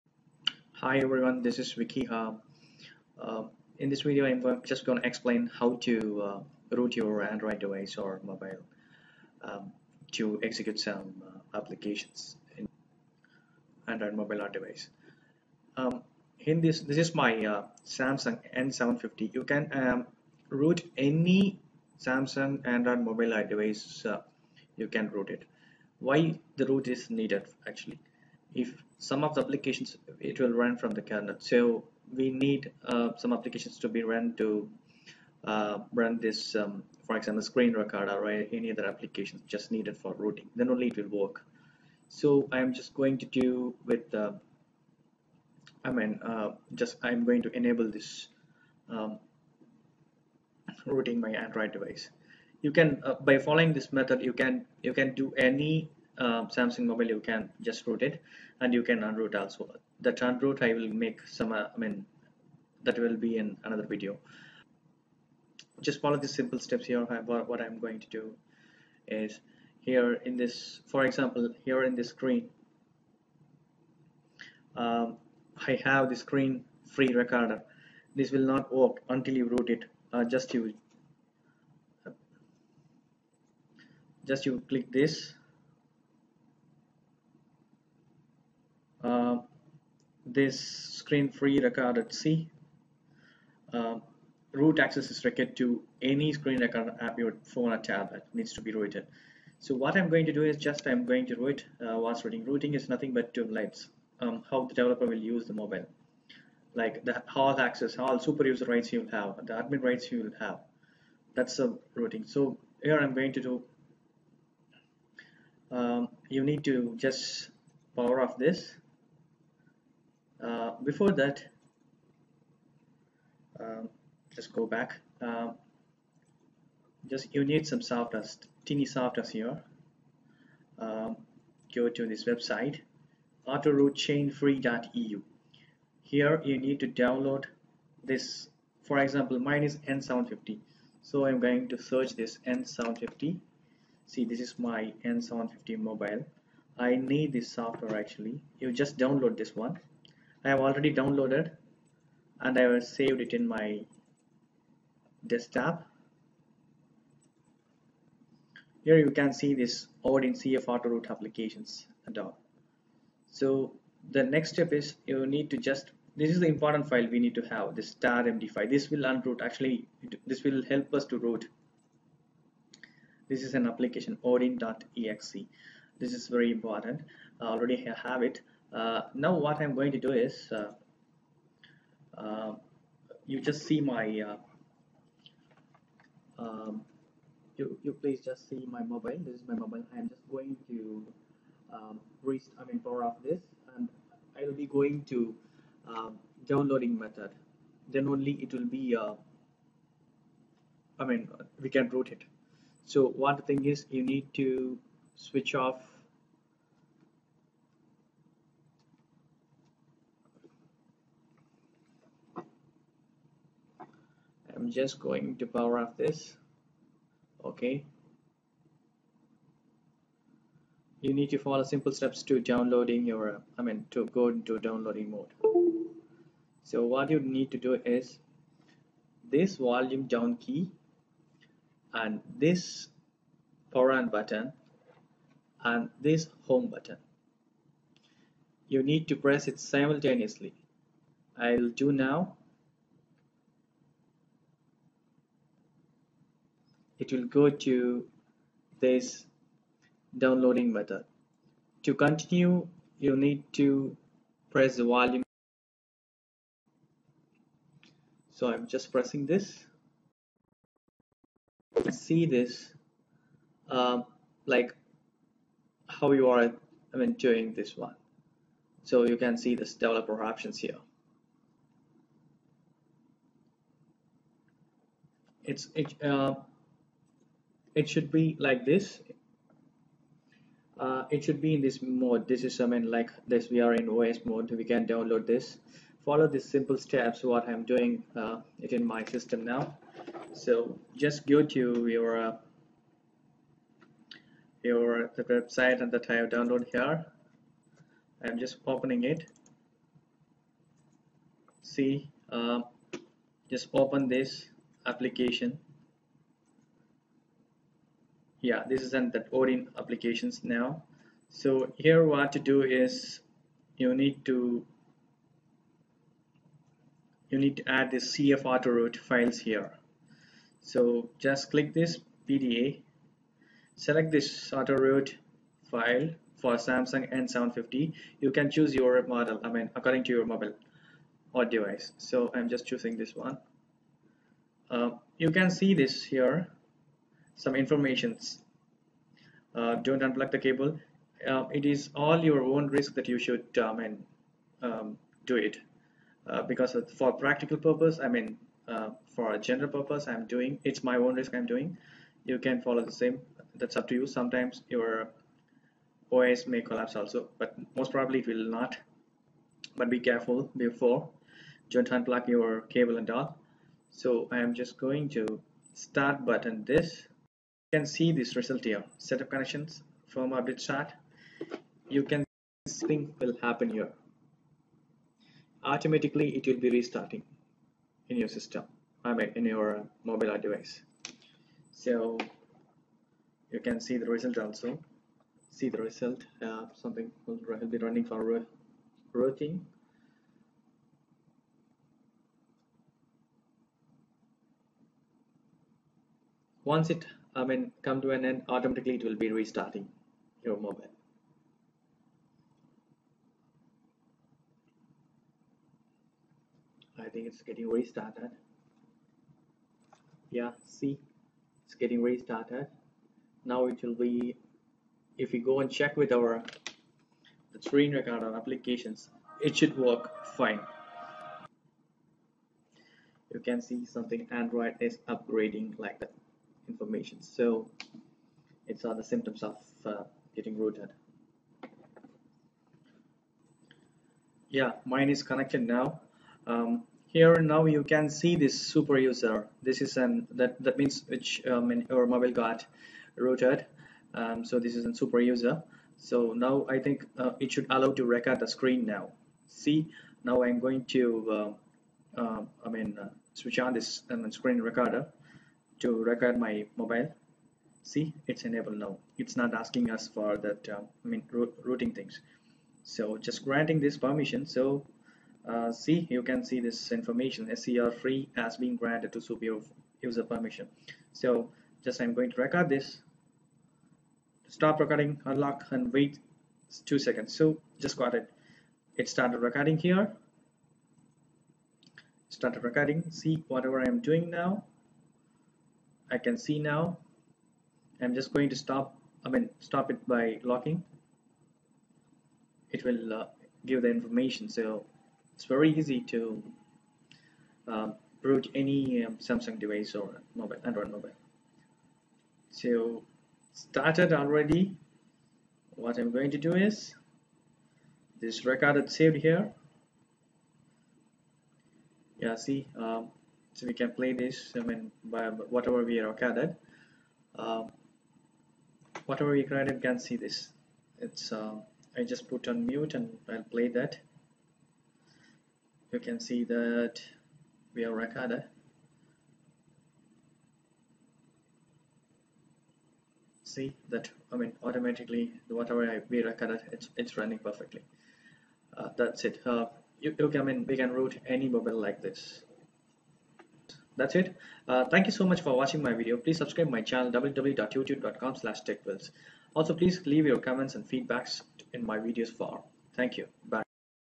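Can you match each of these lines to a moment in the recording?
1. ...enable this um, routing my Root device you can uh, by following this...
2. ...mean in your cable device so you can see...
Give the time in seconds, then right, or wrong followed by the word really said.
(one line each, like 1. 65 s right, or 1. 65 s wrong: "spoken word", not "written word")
1. 47 s wrong: "Android", not "Root"
2. 379 s wrong: "mobile", not "cable".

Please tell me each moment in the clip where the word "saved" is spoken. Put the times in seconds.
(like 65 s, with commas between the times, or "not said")
152 s, 508 s.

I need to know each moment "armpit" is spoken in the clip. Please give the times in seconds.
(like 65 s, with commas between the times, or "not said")
not said.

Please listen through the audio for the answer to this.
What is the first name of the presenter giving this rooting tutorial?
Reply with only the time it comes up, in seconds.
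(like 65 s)
1 s.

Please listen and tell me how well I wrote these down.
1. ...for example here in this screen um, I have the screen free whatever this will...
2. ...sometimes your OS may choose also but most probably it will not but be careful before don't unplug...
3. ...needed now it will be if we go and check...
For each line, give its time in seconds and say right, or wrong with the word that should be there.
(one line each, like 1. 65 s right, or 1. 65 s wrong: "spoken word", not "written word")
1. 70 s wrong: "recorder", not "whatever"
2. 354 s wrong: "collapse", not "choose"
3. 412 s wrong: "restarted", not "needed".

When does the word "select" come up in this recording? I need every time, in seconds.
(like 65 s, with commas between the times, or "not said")
323 s.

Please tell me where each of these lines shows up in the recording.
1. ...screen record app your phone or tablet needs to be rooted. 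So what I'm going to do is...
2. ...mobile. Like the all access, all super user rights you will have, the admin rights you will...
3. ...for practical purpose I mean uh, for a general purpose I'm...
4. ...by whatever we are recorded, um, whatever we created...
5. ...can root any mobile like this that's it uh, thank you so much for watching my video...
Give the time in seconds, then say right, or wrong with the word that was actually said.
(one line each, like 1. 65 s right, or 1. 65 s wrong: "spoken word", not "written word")
1. 96 s right
2. 105 s right
3. 346 s right
4. 515 s right
5. 540 s right.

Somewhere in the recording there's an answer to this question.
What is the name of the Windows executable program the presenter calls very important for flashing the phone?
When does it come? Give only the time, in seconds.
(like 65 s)
174 s.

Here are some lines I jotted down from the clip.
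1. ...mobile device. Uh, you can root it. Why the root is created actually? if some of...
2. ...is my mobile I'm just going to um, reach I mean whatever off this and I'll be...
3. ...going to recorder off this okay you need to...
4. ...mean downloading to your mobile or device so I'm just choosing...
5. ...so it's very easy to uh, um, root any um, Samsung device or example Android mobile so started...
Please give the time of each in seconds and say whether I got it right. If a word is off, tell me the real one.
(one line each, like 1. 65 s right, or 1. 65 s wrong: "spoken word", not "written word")
1. 23 s wrong: "needed", not "created"
2. 189 s wrong: "power", not "whatever"
3. 214 s wrong: "power", not "recorder"
4. 329 s wrong: "according", not "downloading"
5. 494 s wrong: "mobile", not "example".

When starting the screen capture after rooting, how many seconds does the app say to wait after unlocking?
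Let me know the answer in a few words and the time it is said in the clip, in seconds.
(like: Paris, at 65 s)
2, at 476 s.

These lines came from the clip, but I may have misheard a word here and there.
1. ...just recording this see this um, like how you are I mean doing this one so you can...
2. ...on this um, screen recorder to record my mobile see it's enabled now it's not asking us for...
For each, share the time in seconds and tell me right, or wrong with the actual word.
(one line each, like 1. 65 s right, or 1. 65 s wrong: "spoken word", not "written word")
1. 258 s wrong: "pressing", not "recording"
2. 453 s right.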